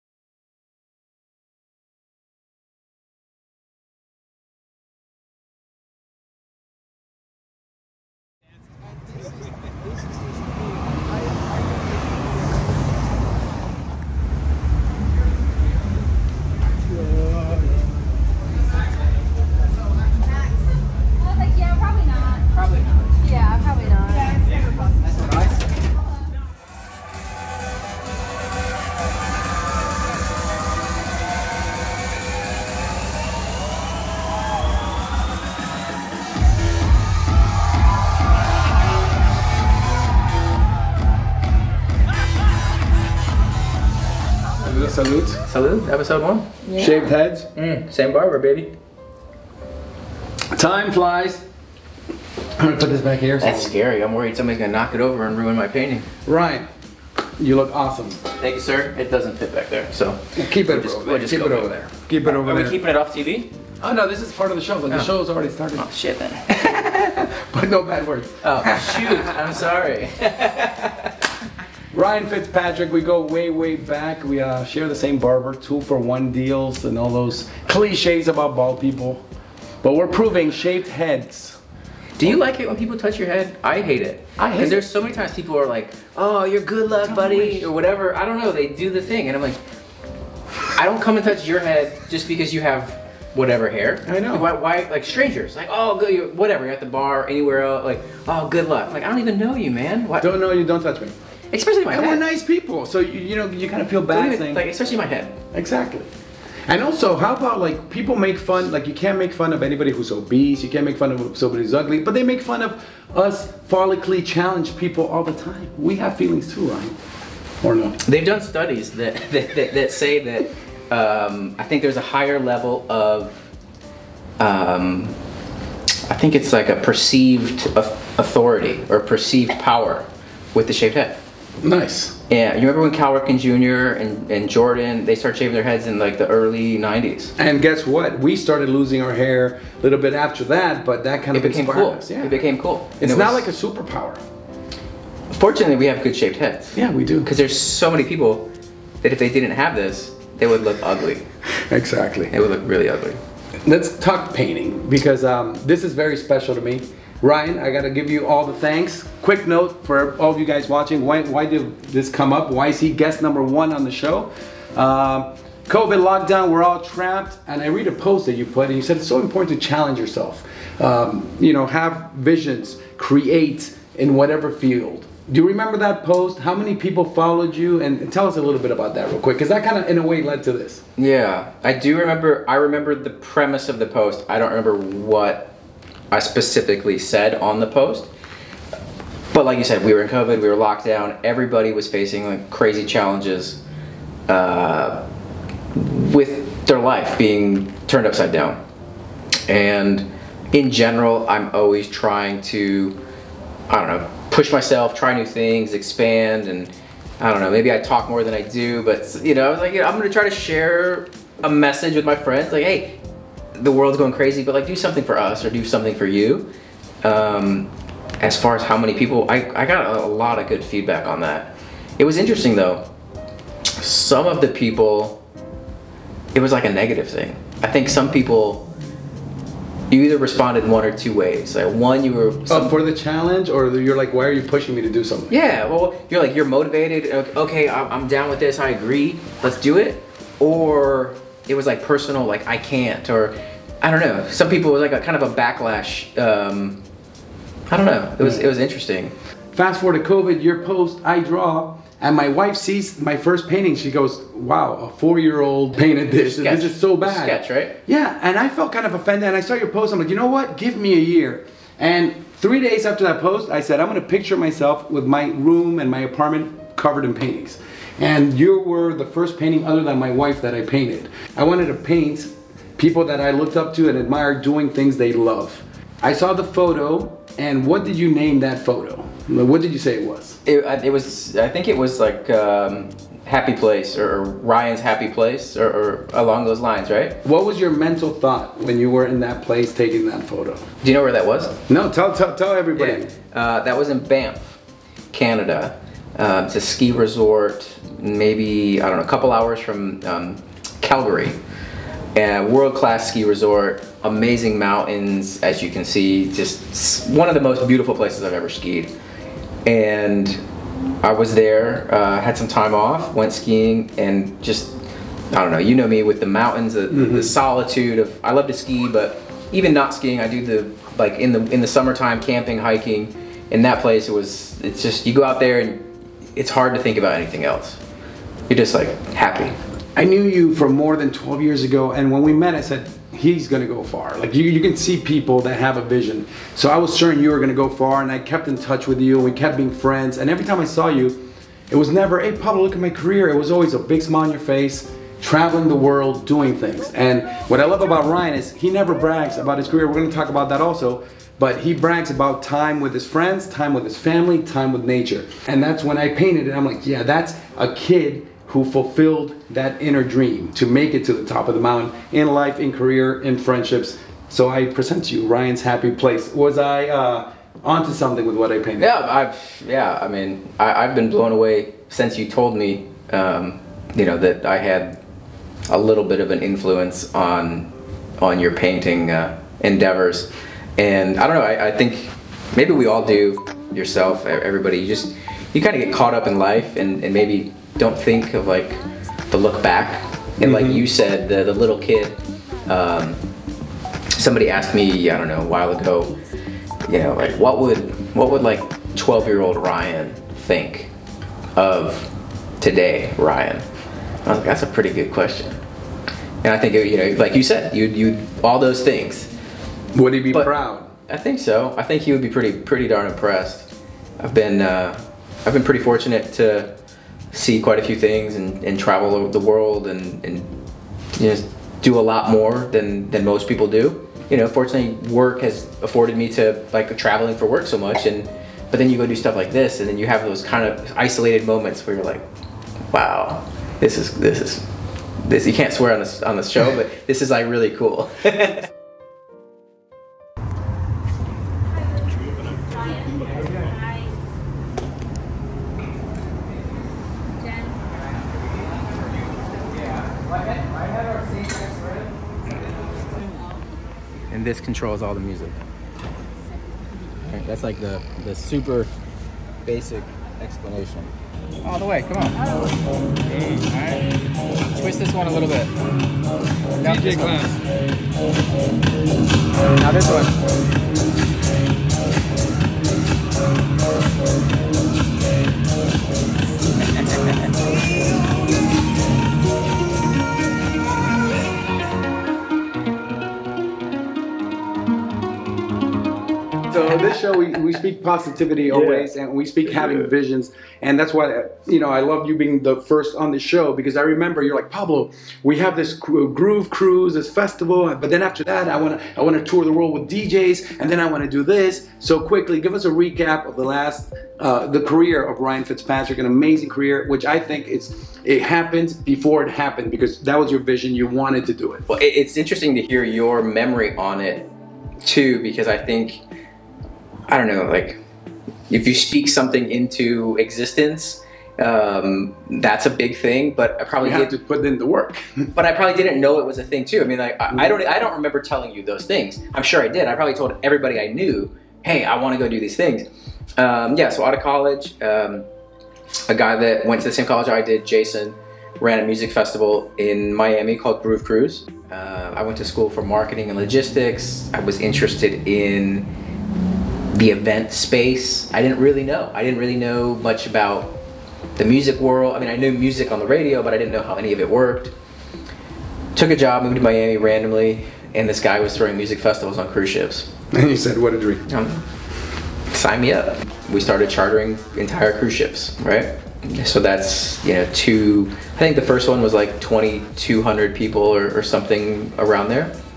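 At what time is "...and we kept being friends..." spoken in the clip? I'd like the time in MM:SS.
05:39.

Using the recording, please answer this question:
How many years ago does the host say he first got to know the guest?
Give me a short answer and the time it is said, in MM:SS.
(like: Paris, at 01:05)
12, at 05:31.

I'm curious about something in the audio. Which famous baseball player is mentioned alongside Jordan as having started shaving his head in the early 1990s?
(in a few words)
Cal Ripken Jr.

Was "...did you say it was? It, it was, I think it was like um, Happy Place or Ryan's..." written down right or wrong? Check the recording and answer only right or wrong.
right.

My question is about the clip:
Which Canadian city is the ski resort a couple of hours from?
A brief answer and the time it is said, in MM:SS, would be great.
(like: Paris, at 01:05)
Calgary, at 05:00.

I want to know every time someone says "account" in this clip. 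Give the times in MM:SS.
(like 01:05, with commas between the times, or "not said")
not said.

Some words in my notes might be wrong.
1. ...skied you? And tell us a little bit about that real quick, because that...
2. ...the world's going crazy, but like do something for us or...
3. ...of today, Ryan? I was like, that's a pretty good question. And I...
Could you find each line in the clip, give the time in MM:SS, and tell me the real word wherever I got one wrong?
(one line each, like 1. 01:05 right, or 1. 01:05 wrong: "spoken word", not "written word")
1. 02:57 wrong: "followed", not "skied"
2. 03:33 right
3. 06:41 right.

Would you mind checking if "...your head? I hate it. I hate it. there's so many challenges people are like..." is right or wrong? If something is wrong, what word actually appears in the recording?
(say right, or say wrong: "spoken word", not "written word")
wrong: "times", not "challenges".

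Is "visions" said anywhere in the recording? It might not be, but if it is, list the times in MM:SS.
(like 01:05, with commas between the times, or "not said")
02:52, 05:35, 08:10, 08:30.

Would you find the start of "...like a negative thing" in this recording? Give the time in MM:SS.
03:46.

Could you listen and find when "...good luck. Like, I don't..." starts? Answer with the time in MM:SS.
01:38.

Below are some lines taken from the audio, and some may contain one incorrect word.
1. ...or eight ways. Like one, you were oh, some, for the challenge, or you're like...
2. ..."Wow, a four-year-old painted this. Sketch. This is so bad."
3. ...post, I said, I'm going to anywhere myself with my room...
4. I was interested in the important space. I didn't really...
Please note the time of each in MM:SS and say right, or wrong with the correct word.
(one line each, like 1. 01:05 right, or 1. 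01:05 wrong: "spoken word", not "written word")
1. 03:50 wrong: "two", not "eight"
2. 04:14 right
3. 04:23 wrong: "picture", not "anywhere"
4. 09:04 wrong: "event", not "important".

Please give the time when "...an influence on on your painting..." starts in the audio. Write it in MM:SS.
06:16.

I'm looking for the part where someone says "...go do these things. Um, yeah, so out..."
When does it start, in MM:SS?
08:52.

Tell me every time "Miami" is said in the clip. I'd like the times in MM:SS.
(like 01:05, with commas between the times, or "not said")
09:00, 09:16.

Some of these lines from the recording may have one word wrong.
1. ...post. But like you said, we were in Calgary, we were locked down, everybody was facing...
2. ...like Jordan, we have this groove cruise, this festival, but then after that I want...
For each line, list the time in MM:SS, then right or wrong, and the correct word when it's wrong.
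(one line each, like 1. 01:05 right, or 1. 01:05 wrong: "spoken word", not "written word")
1. 03:07 wrong: "COVID", not "Calgary"
2. 08:14 wrong: "Pablo", not "Jordan".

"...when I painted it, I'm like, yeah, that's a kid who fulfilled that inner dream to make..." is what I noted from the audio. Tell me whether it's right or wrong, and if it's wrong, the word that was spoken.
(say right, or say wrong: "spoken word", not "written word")
right.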